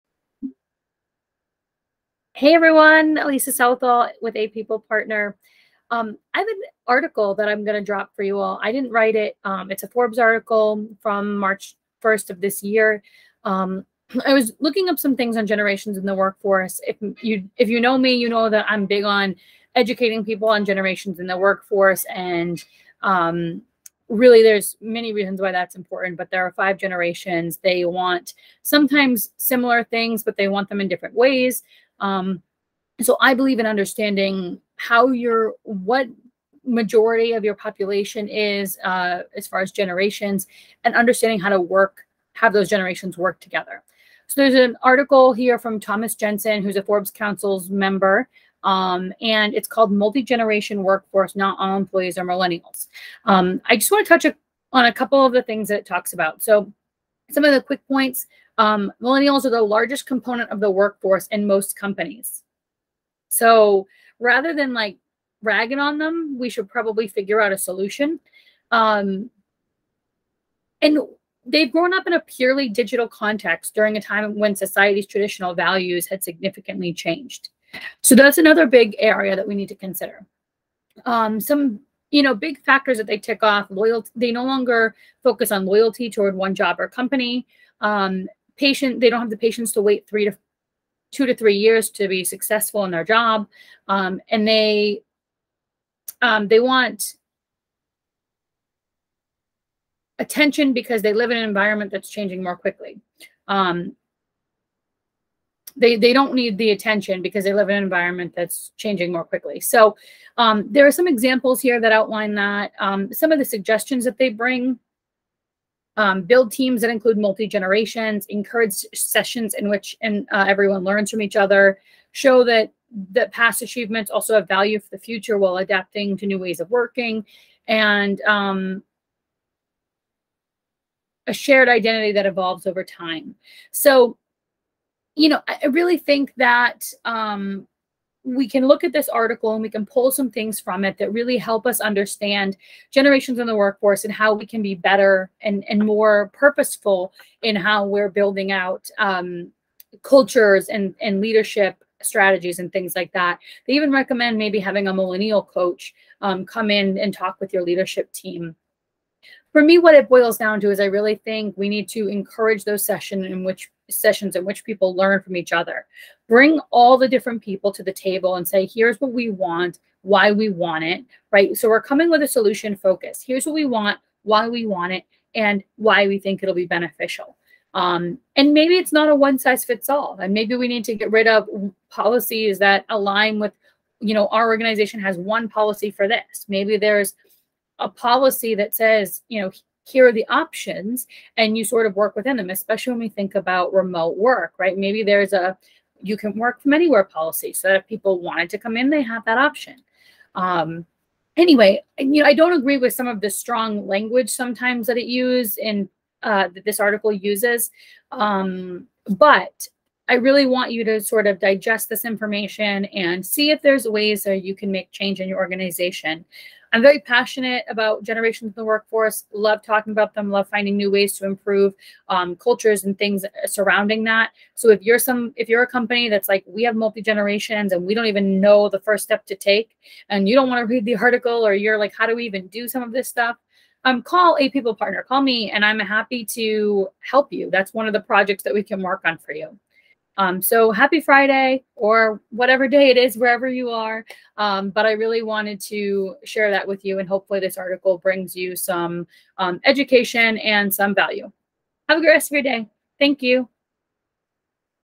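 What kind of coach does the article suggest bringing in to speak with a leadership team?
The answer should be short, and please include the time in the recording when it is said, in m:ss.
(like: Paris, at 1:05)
A millennial coach, at 2:34.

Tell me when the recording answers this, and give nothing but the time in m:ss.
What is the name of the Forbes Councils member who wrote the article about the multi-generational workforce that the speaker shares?
0:45.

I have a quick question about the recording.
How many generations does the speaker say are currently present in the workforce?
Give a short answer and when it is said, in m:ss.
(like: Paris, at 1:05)
5, at 0:26.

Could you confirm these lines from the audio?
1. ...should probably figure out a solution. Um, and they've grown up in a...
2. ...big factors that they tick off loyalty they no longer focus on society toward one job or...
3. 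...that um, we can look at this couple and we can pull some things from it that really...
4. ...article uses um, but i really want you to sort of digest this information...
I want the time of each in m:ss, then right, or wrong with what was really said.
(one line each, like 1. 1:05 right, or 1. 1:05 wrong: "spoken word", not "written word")
1. 1:06 right
2. 1:22 wrong: "loyalty", not "society"
3. 2:16 wrong: "article", not "couple"
4. 3:26 right.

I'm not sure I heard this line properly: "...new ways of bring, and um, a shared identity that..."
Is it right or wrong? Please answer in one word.
wrong.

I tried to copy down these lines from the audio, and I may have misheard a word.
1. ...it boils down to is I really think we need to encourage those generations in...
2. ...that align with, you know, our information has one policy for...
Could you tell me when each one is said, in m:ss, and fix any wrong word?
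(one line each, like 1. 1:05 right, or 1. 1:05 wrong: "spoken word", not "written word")
1. 2:39 wrong: "sessions", not "generations"
2. 3:02 wrong: "organization", not "information".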